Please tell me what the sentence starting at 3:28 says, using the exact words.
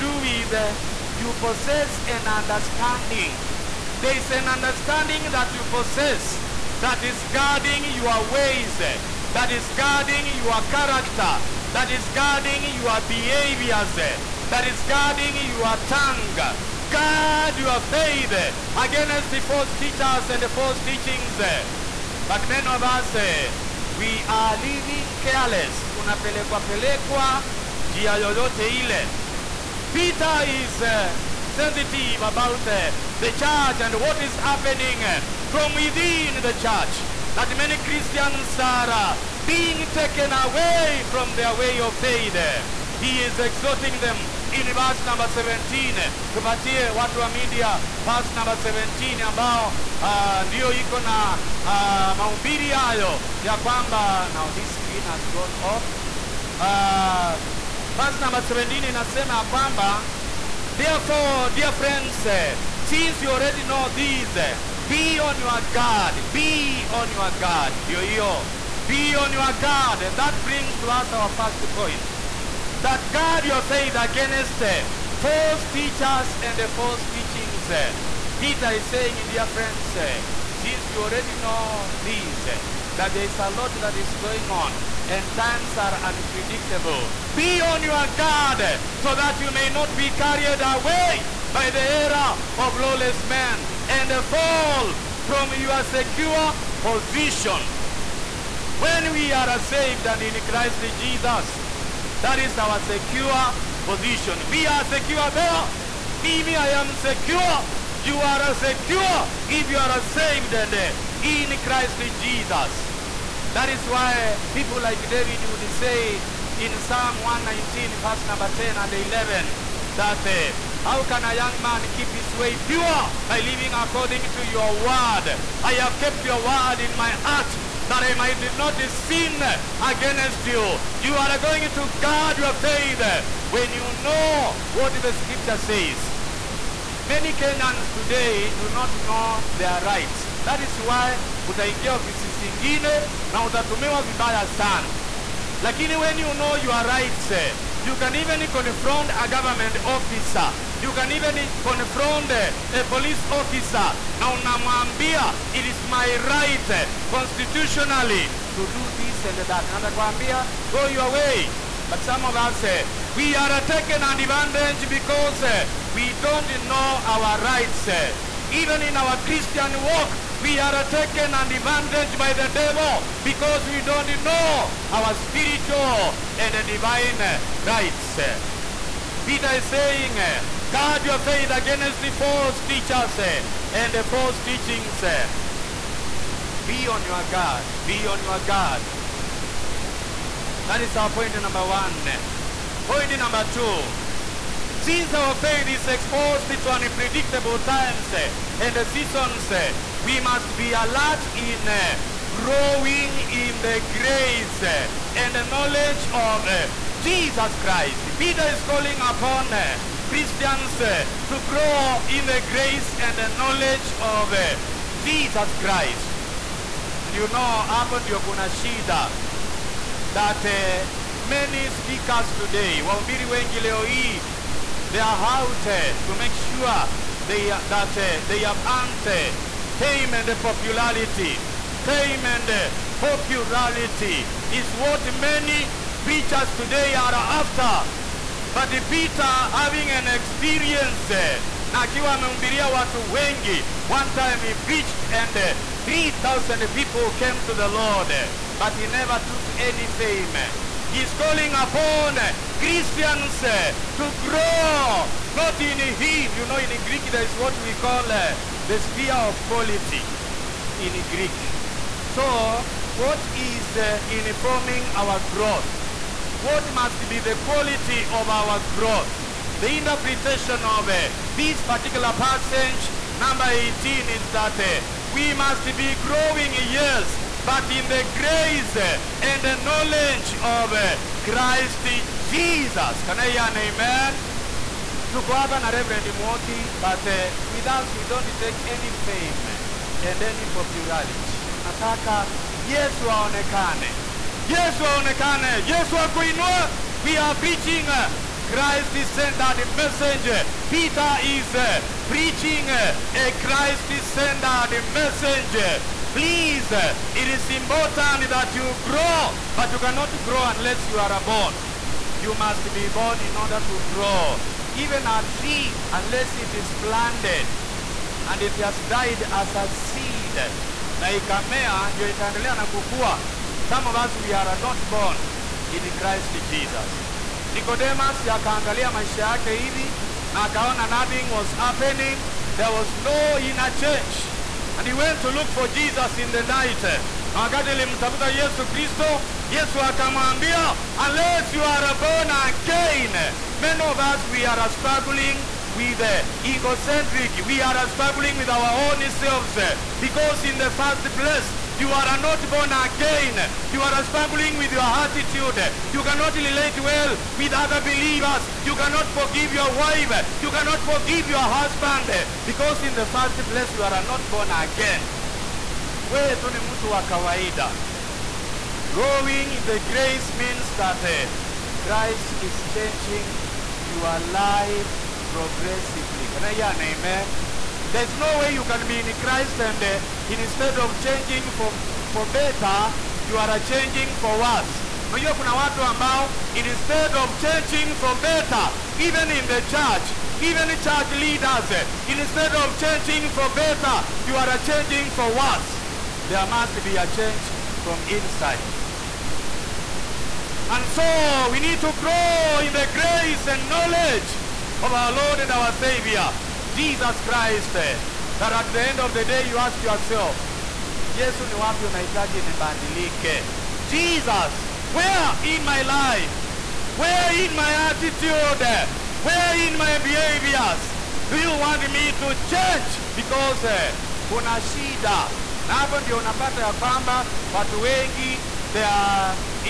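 Peter is calling upon uh, Christians to grow in the grace and the knowledge of Jesus Christ.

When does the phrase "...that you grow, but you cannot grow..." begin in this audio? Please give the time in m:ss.
5:08.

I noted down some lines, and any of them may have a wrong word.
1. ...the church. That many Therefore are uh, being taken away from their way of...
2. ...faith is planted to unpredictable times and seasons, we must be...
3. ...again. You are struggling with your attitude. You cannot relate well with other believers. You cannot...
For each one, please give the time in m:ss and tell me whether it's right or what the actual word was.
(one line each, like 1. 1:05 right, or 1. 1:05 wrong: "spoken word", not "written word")
1. 0:36 wrong: "Christians", not "Therefore"
2. 3:15 wrong: "exposed", not "planted"
3. 5:52 right.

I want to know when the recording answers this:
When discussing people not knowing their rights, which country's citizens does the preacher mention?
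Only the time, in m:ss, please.
2:17.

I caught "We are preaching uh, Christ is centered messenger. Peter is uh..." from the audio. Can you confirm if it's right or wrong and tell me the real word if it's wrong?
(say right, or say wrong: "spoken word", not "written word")
right.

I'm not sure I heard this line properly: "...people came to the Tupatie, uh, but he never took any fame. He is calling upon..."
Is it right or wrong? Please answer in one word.
wrong.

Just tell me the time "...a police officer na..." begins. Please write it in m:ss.
2:32.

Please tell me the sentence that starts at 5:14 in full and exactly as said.
Even a tree, unless it is planted and it has died as a seed, na ikamea ndio itaendelea na kukua.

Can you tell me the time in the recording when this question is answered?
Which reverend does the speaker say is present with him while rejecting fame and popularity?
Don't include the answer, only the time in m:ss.
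4:45.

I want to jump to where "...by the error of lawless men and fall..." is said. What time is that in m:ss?
1:31.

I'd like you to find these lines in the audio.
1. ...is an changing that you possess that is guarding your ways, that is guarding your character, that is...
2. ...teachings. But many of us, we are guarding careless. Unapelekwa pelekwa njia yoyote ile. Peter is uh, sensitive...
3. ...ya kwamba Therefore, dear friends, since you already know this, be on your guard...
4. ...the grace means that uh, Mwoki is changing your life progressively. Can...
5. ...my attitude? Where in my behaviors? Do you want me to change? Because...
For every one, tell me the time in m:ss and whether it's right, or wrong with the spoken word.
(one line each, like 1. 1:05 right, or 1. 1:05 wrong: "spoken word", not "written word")
1. 0:04 wrong: "understanding", not "changing"
2. 0:20 wrong: "living", not "guarding"
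3. 0:59 right
4. 6:09 wrong: "Christ", not "Mwoki"
5. 6:57 right.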